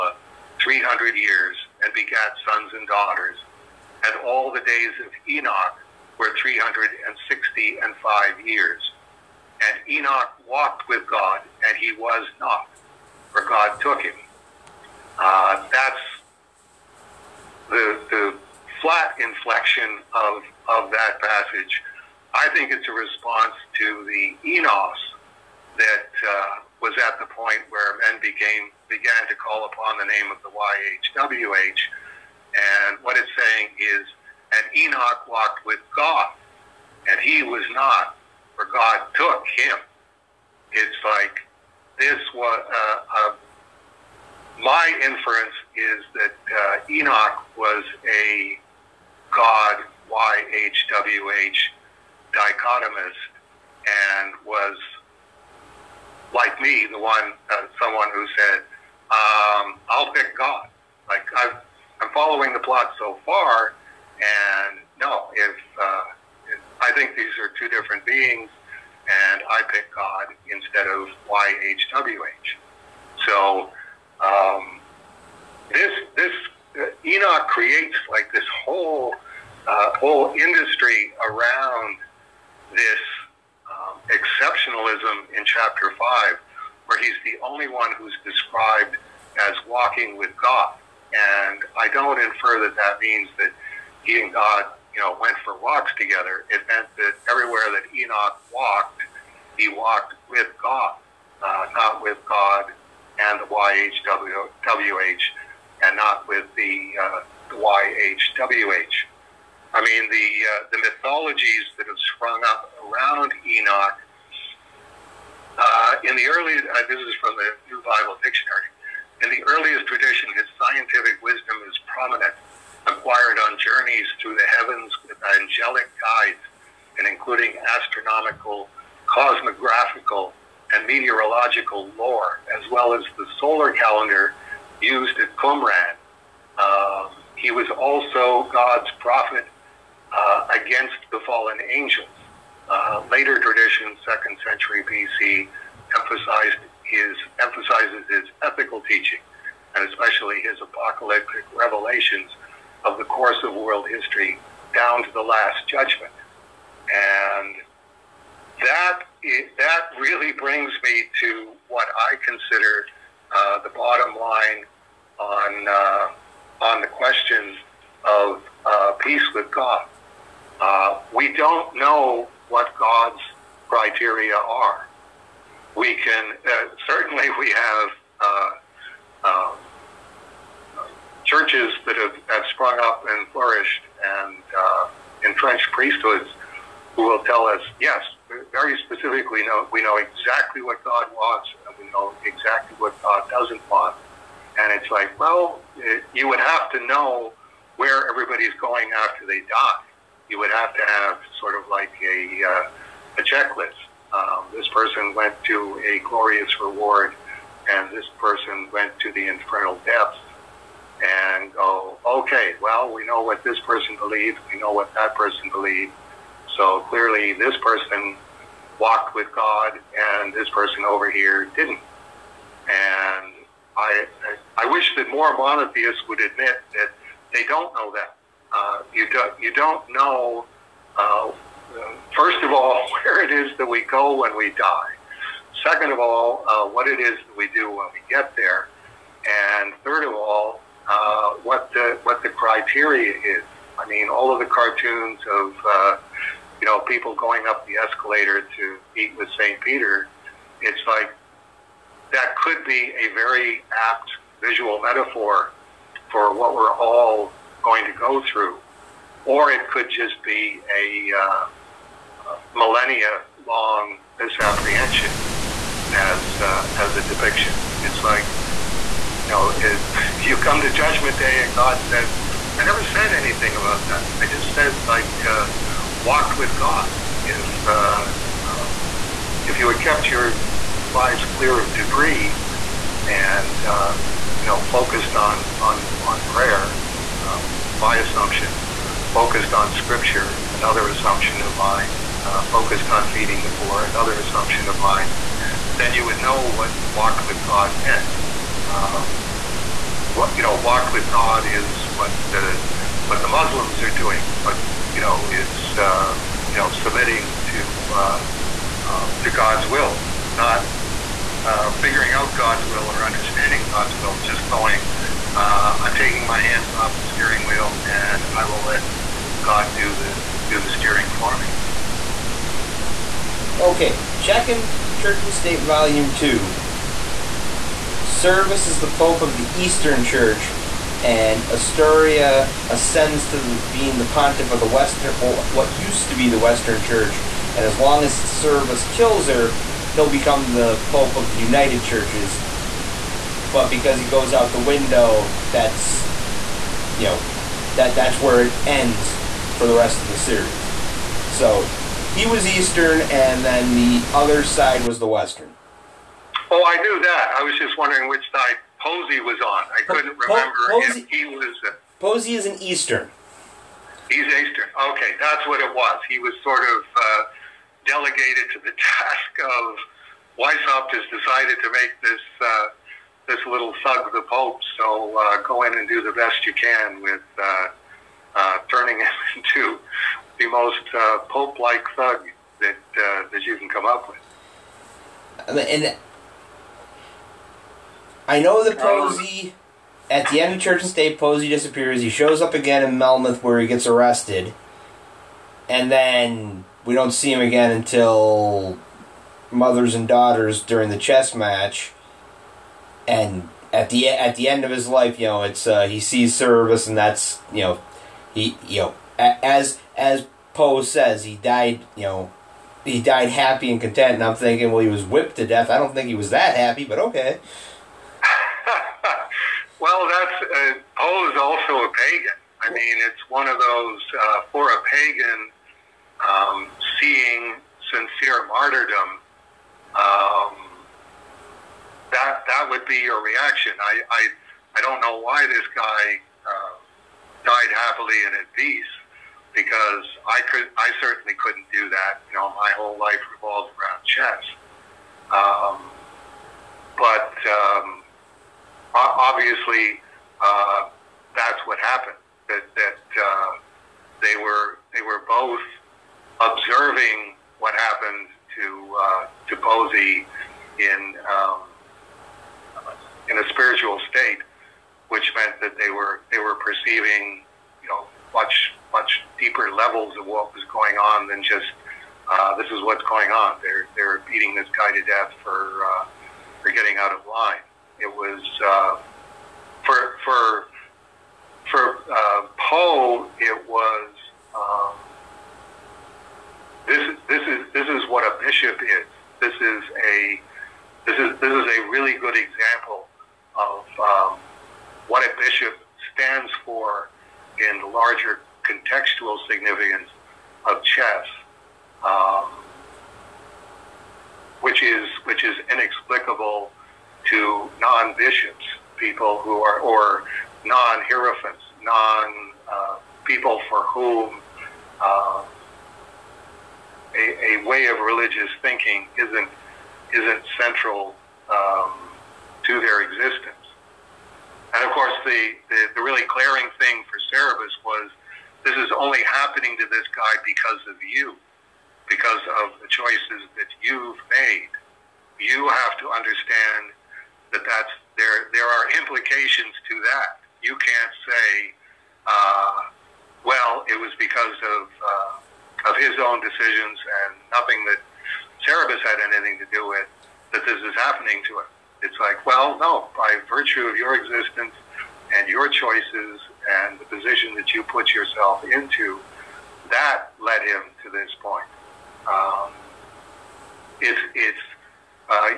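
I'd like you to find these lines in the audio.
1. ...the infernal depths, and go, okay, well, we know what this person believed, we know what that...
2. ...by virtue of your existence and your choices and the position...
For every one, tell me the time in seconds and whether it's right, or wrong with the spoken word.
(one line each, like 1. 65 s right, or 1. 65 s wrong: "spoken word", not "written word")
1. 209 s right
2. 553 s right.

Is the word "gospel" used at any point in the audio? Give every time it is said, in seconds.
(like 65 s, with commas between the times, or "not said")
not said.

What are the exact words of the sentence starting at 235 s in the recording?
Second of all, uh, what it is that we do when we get there.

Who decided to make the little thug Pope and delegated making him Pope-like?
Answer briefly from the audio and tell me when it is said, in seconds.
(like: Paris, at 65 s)
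Weishaupt, at 370 s.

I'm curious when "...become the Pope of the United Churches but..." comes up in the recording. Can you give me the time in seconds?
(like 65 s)
340 s.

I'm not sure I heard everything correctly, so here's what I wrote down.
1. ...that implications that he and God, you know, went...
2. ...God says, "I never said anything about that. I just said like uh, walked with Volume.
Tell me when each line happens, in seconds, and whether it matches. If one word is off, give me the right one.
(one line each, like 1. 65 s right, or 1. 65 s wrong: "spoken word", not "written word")
1. 92 s wrong: "means", not "implications"
2. 271 s wrong: "God", not "Volume".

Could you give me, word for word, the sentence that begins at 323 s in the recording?
Okay, checking Church and State Volume Two.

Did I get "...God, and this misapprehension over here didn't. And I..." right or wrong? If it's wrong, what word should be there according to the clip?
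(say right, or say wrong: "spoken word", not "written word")
wrong: "person", not "misapprehension".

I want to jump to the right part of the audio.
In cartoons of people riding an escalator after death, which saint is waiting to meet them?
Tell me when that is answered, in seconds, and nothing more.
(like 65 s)
249 s.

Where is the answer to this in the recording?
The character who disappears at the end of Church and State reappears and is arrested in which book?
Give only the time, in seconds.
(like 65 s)
392 s.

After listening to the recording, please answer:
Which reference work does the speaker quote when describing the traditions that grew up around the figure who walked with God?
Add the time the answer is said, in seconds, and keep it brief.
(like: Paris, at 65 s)
New Bible Dictionary, at 117 s.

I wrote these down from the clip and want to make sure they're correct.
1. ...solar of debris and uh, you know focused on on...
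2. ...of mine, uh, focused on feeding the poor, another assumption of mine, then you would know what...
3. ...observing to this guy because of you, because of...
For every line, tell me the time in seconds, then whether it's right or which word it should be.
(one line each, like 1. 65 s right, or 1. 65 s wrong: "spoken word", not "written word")
1. 281 s wrong: "clear", not "solar"
2. 291 s right
3. 529 s wrong: "happening", not "observing".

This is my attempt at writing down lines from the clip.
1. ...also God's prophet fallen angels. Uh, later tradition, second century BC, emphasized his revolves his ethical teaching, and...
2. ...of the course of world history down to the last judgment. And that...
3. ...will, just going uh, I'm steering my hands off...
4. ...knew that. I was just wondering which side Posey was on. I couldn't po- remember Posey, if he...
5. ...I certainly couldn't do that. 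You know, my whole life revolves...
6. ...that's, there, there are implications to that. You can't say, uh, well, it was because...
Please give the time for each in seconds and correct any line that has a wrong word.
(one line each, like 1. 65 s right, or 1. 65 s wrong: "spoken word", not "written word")
1. 137 s wrong: "emphasizes", not "revolves"
2. 152 s right
3. 314 s wrong: "taking", not "steering"
4. 356 s right
5. 440 s right
6. 537 s right.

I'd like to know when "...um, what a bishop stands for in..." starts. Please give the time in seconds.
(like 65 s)
493 s.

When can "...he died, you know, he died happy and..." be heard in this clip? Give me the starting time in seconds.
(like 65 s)
411 s.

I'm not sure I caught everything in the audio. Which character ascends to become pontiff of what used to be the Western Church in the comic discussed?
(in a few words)
Astoria.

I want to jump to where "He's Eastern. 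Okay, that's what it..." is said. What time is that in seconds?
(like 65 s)
364 s.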